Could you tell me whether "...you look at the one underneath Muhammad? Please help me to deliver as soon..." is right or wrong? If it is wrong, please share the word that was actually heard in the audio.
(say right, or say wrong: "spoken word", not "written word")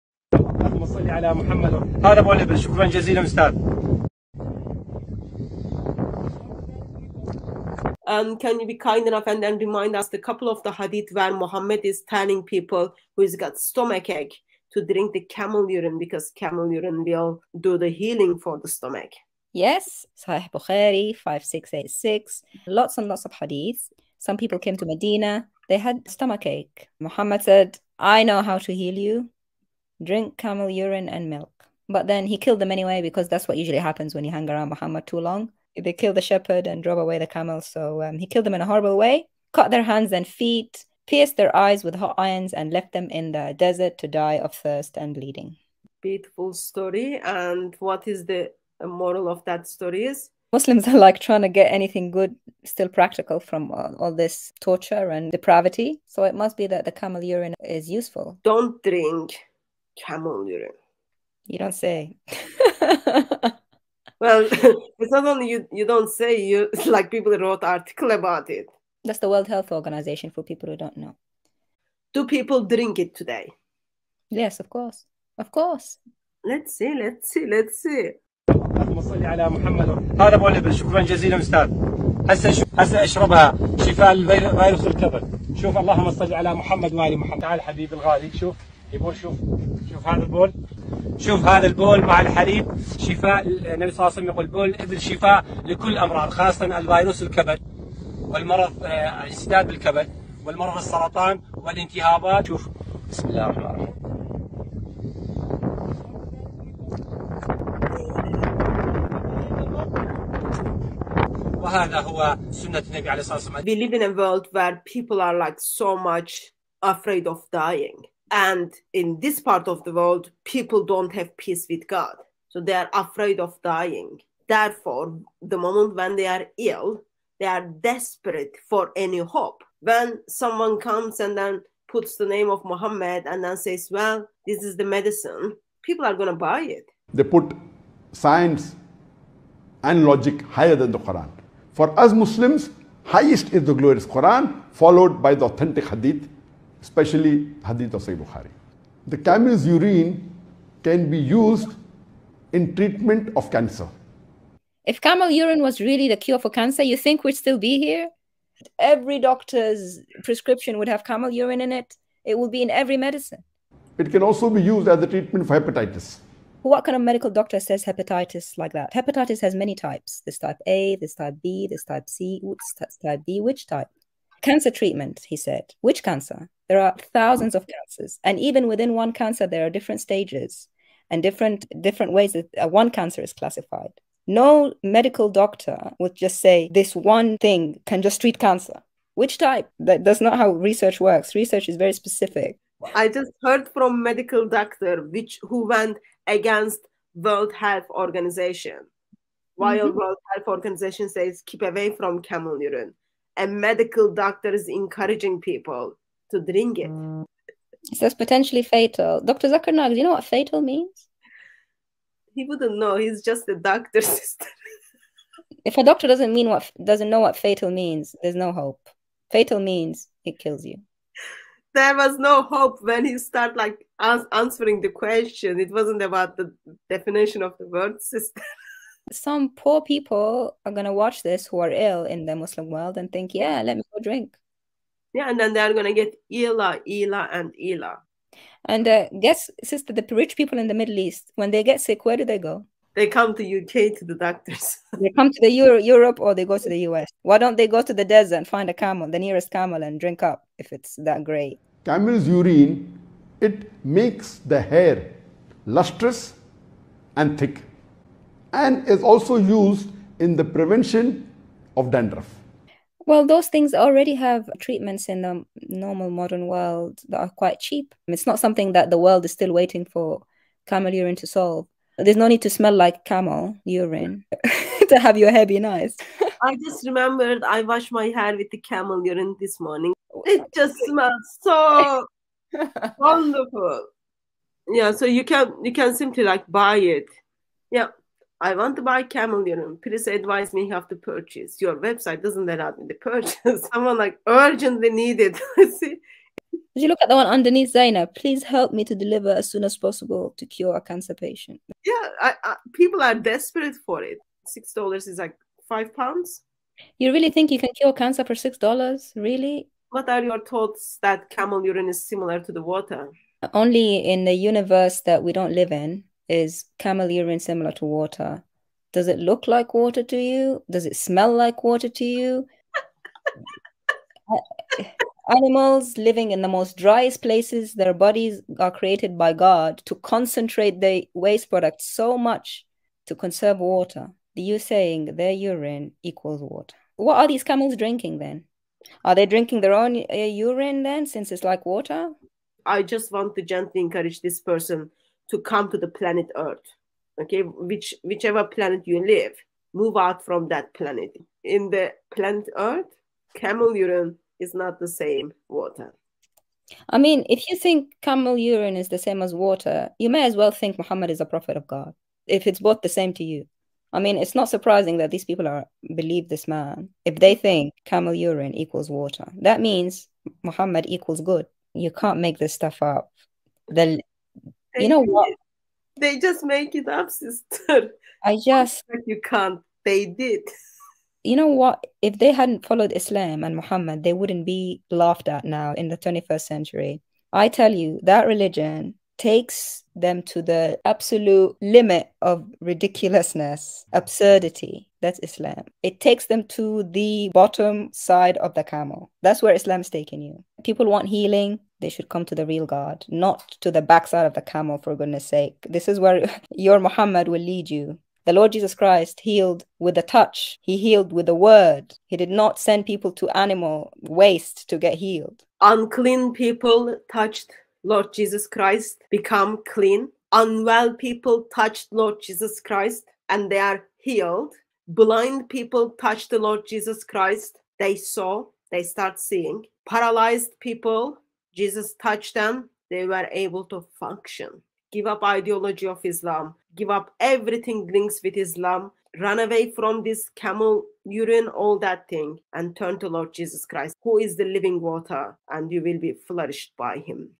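wrong: "Zaina", not "Muhammad".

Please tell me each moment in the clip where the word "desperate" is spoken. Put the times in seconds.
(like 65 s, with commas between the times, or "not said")
127 s, 303 s.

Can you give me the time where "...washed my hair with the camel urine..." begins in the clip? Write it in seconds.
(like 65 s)
277 s.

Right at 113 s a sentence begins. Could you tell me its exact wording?
We live in a world where people are like so much afraid of dying.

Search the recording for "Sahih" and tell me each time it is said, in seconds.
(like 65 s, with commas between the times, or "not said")
20 s, 148 s.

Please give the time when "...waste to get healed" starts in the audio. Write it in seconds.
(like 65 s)
414 s.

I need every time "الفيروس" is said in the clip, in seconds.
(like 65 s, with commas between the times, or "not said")
84 s, 96 s.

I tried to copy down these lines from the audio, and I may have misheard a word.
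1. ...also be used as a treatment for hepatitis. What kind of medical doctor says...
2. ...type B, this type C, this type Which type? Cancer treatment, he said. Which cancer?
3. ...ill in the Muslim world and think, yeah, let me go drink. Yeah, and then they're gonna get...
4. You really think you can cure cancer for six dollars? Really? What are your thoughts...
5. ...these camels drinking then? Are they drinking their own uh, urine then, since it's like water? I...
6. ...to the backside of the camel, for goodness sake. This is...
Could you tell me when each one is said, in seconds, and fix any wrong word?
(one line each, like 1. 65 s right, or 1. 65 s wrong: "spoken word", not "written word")
1. 164 s right
2. 171 s right
3. 231 s right
4. 306 s right
5. 337 s right
6. 403 s right.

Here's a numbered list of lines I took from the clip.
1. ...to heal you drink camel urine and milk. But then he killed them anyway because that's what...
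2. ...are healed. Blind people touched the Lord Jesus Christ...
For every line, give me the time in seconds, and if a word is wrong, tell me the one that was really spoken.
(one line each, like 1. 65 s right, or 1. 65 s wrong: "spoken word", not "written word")
1. 28 s right
2. 423 s right.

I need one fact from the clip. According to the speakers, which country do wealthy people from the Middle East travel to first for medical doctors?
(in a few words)
UK.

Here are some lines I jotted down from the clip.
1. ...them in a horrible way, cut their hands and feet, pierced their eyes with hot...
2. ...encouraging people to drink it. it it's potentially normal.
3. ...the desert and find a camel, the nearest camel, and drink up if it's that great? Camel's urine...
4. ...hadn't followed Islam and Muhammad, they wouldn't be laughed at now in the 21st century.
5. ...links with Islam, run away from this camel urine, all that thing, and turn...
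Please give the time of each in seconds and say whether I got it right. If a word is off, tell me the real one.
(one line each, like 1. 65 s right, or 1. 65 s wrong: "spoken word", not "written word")
1. 38 s right
2. 204 s wrong: "fatal", not "normal"
3. 247 s right
4. 382 s right
5. 437 s right.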